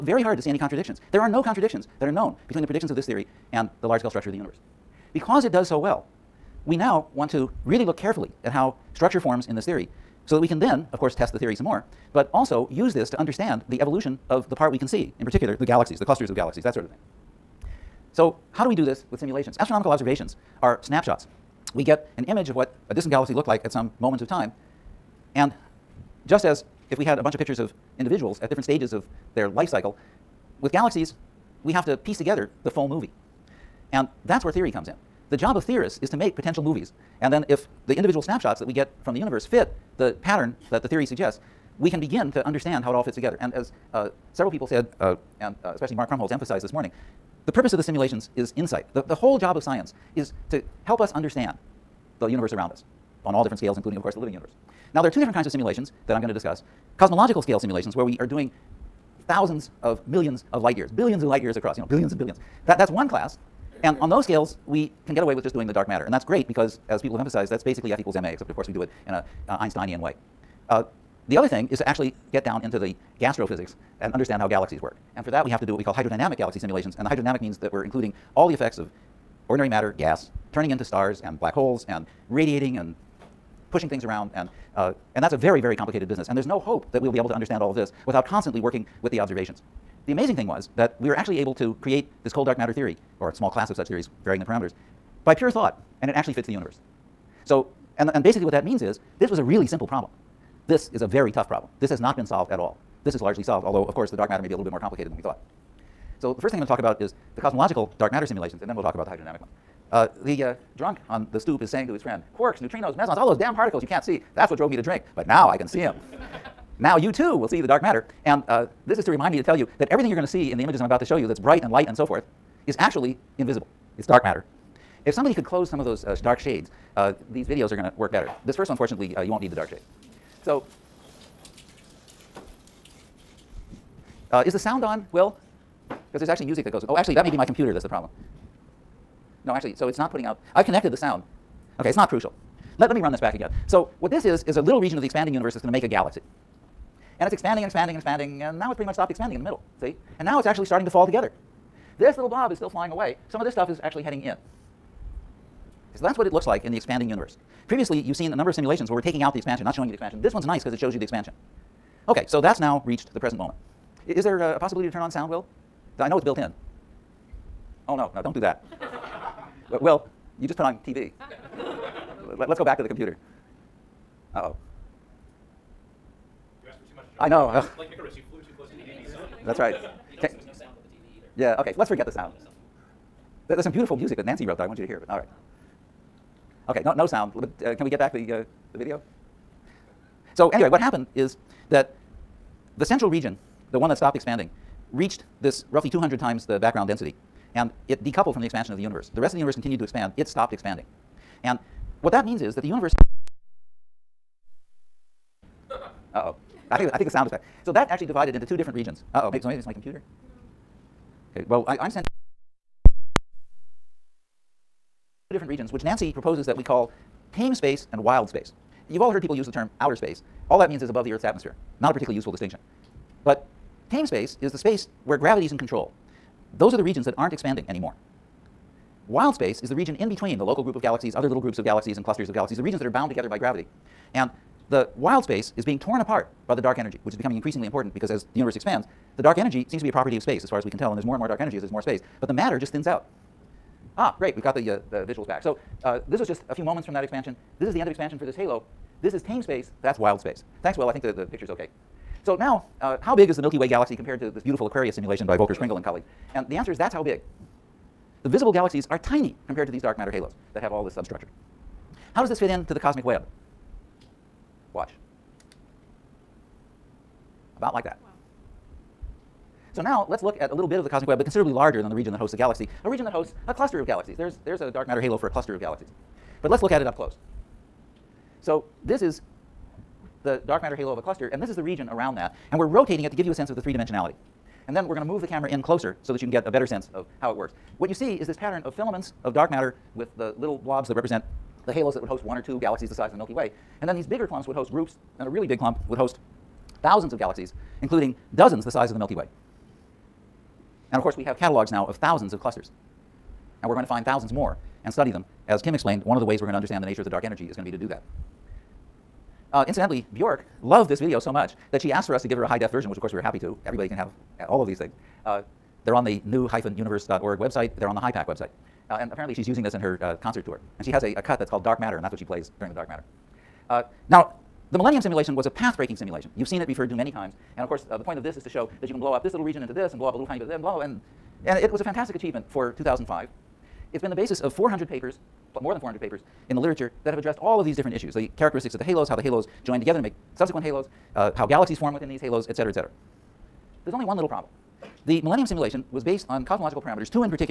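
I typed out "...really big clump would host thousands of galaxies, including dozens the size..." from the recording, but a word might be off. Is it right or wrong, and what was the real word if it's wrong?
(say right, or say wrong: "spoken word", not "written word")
right.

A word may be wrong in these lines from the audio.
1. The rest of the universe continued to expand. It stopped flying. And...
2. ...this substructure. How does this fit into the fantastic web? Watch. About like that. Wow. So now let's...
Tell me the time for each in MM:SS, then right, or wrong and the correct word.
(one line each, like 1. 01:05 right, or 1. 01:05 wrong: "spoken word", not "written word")
1. 03:19 wrong: "expanding", not "flying"
2. 04:20 wrong: "cosmic", not "fantastic".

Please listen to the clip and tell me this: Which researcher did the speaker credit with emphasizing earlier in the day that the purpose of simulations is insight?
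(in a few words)
Mark Krumholz.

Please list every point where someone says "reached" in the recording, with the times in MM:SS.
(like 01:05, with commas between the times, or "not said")
02:42, 03:14.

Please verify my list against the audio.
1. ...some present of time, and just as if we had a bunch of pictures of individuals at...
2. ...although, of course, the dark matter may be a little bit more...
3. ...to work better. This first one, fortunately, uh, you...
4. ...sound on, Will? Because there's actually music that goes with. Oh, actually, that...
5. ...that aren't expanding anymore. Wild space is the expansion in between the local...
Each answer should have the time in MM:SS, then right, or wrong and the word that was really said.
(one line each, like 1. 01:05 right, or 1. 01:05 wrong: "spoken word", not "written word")
1. 00:23 wrong: "moment", not "present"
2. 01:43 right
3. 02:07 right
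4. 02:14 right
5. 03:47 wrong: "region", not "expansion".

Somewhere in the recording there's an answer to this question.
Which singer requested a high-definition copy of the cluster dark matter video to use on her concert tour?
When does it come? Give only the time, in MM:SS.
05:10.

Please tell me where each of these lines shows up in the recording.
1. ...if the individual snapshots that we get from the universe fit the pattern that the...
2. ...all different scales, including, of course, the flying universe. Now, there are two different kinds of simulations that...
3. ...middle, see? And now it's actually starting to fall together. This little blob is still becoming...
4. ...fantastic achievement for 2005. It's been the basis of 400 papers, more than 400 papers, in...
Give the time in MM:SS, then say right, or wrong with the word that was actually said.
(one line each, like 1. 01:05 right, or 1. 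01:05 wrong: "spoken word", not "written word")
1. 00:37 right
2. 00:53 wrong: "living", not "flying"
3. 02:29 wrong: "flying", not "becoming"
4. 05:31 right.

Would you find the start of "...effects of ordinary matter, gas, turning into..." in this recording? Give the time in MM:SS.
01:18.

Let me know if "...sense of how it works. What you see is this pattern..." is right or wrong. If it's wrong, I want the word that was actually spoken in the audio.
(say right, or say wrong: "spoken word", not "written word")
right.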